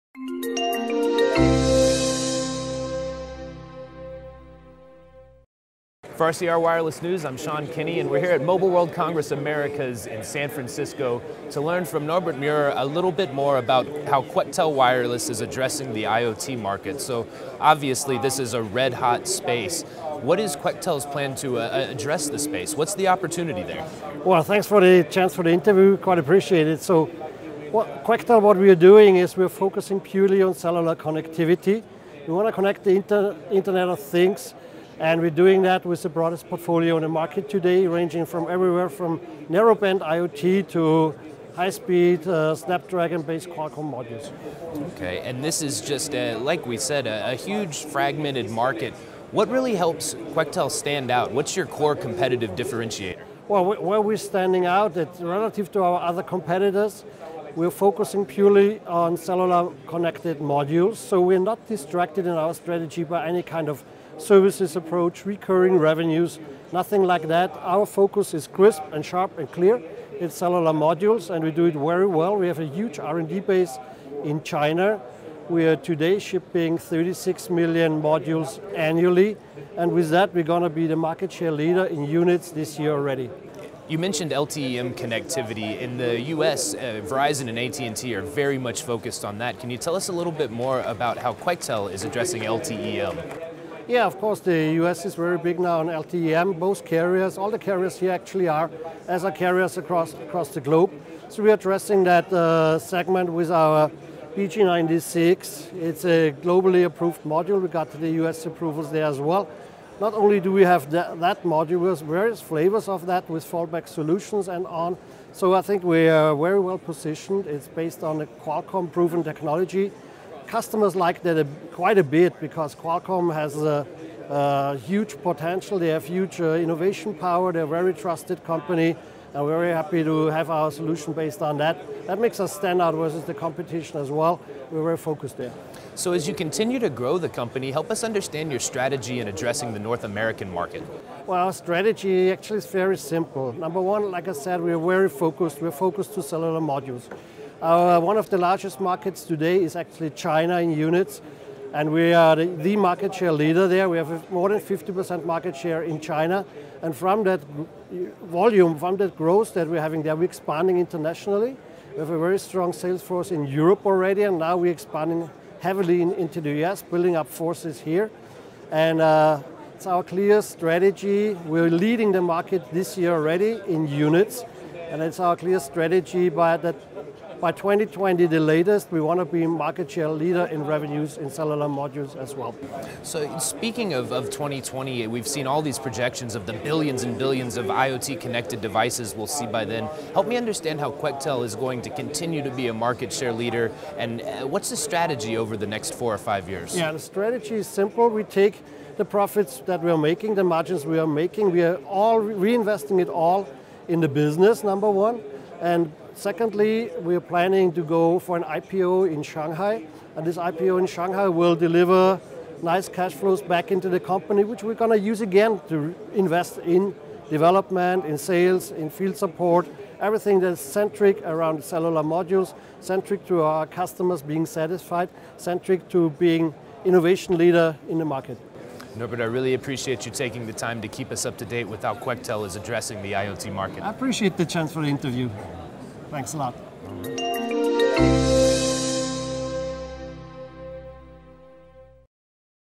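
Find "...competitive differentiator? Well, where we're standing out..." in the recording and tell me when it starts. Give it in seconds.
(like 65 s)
51 s.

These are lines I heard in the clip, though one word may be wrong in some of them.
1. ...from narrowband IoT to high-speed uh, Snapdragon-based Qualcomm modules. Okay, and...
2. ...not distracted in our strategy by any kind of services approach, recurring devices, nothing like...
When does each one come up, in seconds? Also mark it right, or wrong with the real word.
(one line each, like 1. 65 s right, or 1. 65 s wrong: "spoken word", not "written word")
1. 38 s right
2. 61 s wrong: "revenues", not "devices".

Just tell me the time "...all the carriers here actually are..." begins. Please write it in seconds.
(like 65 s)
97 s.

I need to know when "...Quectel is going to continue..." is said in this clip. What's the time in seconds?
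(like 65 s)
190 s.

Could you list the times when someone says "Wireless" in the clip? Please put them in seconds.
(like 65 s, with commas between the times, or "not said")
6 s, 14 s.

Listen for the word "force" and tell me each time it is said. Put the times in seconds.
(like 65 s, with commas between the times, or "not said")
163 s, 167 s.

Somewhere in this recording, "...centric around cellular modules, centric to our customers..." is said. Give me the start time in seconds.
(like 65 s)
220 s.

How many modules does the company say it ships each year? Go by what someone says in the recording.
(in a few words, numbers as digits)
36 million.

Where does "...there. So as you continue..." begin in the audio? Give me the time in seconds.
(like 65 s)
135 s.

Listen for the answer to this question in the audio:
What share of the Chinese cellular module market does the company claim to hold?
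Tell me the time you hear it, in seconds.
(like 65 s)
154 s.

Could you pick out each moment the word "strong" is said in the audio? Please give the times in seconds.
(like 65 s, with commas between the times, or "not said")
162 s.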